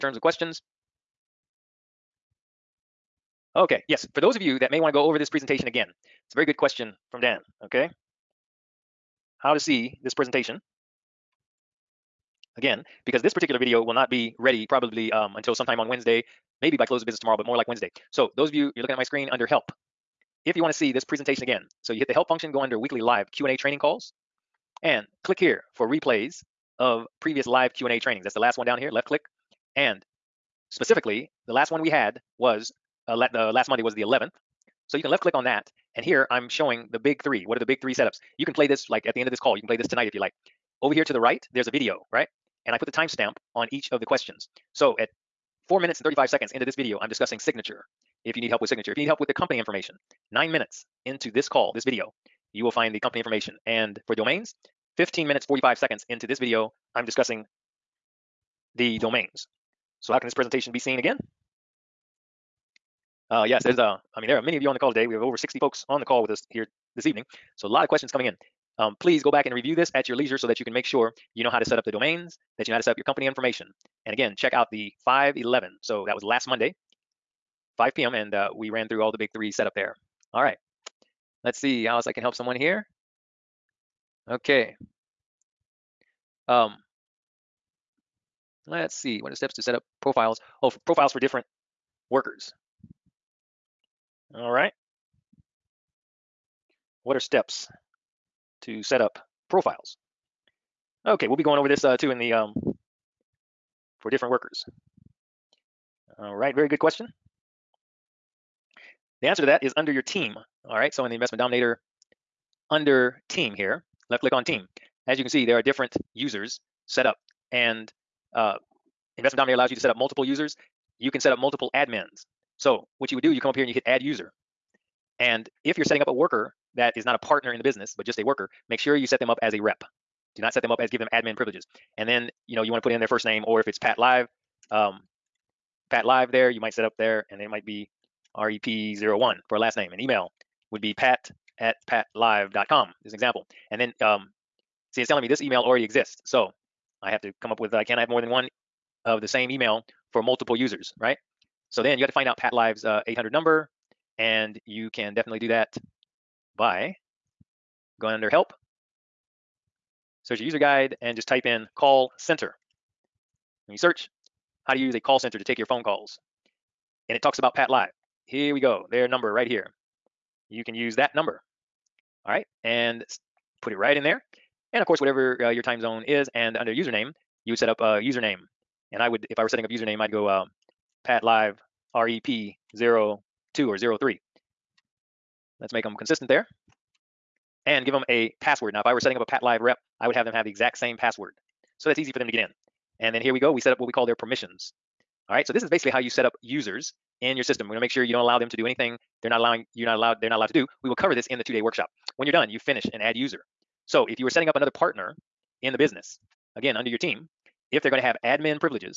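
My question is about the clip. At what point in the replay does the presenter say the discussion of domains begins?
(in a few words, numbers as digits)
15 minutes, 45 seconds.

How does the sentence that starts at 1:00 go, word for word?
So how can this presentation be seen again?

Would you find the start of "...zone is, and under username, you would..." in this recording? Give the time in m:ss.
2:55.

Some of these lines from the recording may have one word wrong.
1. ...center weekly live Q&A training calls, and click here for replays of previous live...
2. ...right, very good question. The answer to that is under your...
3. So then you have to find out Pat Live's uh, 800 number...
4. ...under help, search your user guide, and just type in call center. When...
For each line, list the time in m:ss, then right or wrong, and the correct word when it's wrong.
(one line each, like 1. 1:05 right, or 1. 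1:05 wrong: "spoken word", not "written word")
1. 0:22 wrong: "under", not "center"
2. 1:46 right
3. 2:31 right
4. 2:38 right.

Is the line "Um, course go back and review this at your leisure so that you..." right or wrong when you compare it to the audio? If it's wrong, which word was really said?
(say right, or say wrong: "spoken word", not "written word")
wrong: "please", not "course".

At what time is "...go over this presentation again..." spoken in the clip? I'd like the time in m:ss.
0:04.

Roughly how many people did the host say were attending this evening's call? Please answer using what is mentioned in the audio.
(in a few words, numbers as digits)
over 60.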